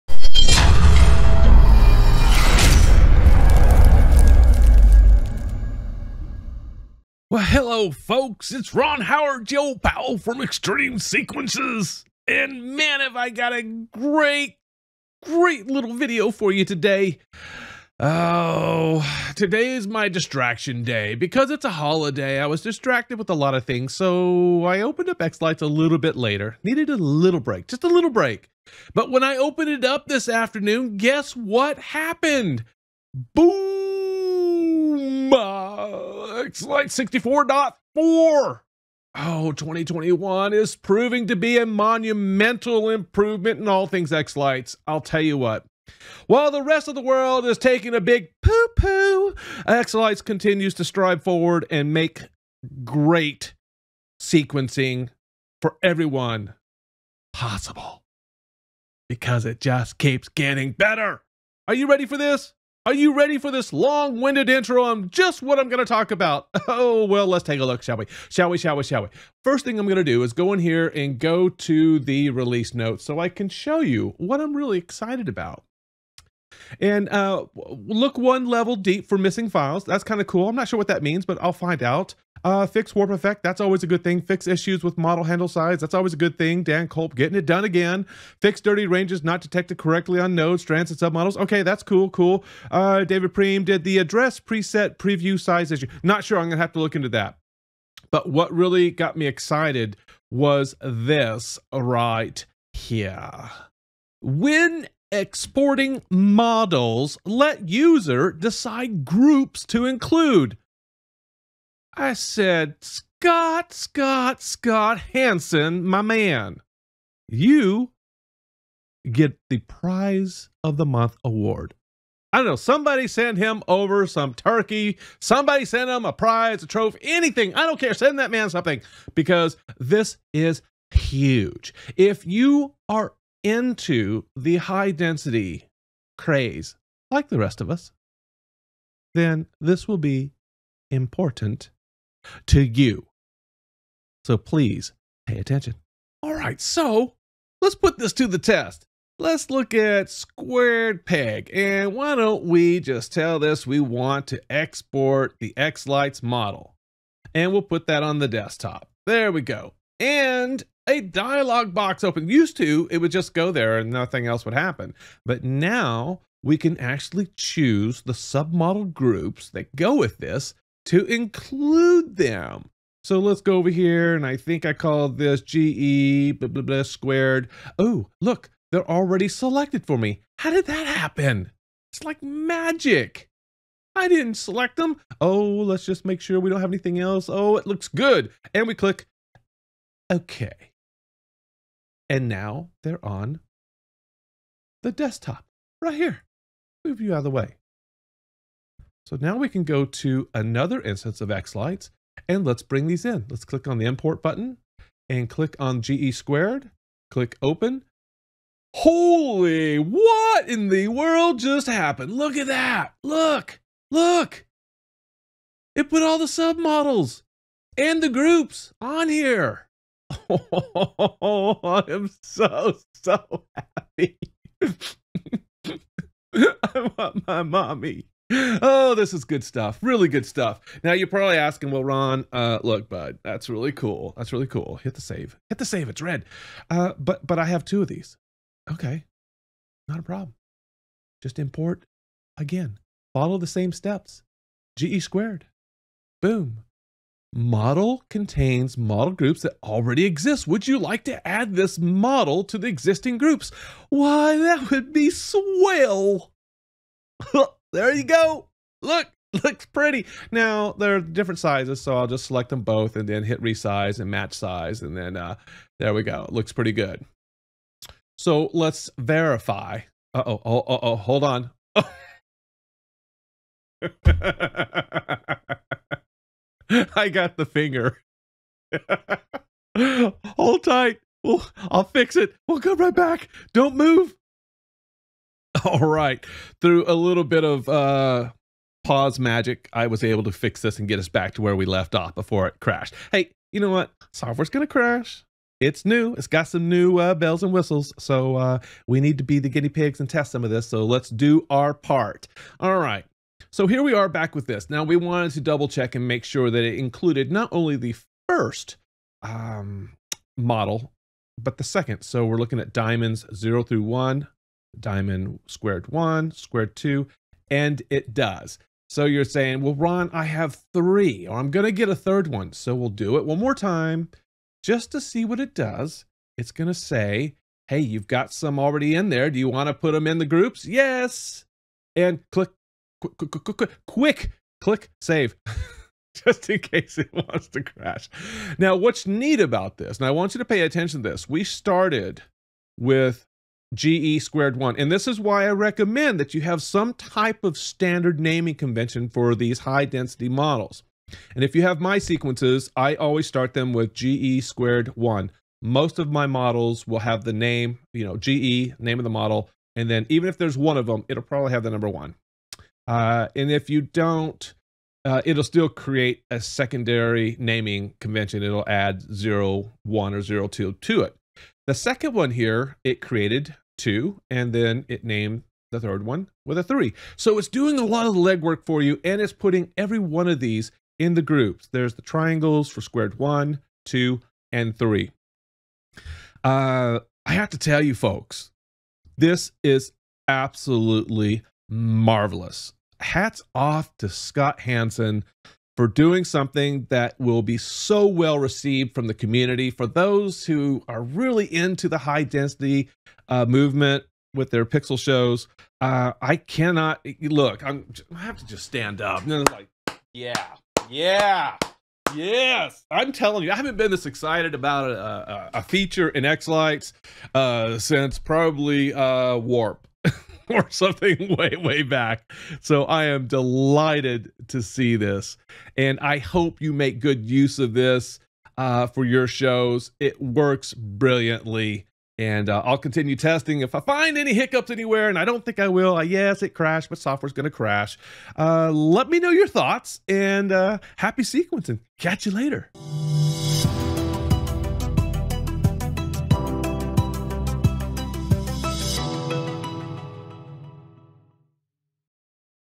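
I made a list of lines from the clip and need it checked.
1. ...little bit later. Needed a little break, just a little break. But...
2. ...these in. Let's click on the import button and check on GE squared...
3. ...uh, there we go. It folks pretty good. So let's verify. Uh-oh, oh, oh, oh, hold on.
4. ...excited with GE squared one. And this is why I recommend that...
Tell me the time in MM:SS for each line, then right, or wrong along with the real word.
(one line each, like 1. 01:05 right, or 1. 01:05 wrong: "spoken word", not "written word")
1. 00:25 right
2. 03:22 wrong: "click", not "check"
3. 04:25 wrong: "looks", not "folks"
4. 05:41 wrong: "started", not "excited".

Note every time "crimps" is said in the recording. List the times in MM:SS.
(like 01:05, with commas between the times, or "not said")
not said.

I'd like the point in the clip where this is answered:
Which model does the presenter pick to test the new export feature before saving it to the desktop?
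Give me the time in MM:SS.
02:30.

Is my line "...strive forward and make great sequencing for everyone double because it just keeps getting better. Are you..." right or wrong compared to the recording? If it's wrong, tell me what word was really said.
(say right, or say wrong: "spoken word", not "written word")
wrong: "possible", not "double".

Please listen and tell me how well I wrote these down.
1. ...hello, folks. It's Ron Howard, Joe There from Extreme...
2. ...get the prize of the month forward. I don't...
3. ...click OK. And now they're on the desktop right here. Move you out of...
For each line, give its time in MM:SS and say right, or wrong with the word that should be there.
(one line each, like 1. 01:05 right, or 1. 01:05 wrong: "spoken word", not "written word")
1. 00:07 wrong: "Powell", not "There"
2. 01:59 wrong: "award", not "forward"
3. 03:08 right.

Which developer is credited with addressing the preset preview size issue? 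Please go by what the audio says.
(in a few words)
David Preem.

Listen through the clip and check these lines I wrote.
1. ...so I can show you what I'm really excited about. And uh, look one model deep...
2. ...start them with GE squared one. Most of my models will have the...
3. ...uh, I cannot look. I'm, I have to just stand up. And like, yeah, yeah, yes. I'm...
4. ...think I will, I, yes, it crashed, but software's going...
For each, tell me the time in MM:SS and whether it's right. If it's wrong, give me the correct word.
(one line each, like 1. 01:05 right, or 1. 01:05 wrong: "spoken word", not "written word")
1. 01:13 wrong: "level", not "model"
2. 05:53 right
3. 06:45 right
4. 07:15 right.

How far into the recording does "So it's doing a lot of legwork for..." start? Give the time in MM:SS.
06:17.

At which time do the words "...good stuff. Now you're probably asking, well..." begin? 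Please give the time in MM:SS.
03:50.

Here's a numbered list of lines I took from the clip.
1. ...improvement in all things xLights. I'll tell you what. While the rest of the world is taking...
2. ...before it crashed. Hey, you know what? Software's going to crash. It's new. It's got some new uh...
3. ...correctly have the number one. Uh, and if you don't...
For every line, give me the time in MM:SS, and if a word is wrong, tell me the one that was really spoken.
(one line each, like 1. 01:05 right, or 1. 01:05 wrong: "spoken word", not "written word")
1. 00:42 right
2. 04:52 right
3. 06:01 wrong: "probably", not "correctly".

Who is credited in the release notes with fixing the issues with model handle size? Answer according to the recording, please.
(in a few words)
Dan Kulp.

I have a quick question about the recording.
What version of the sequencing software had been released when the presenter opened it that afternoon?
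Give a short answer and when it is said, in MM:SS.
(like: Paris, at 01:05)
64.4, at 00:36.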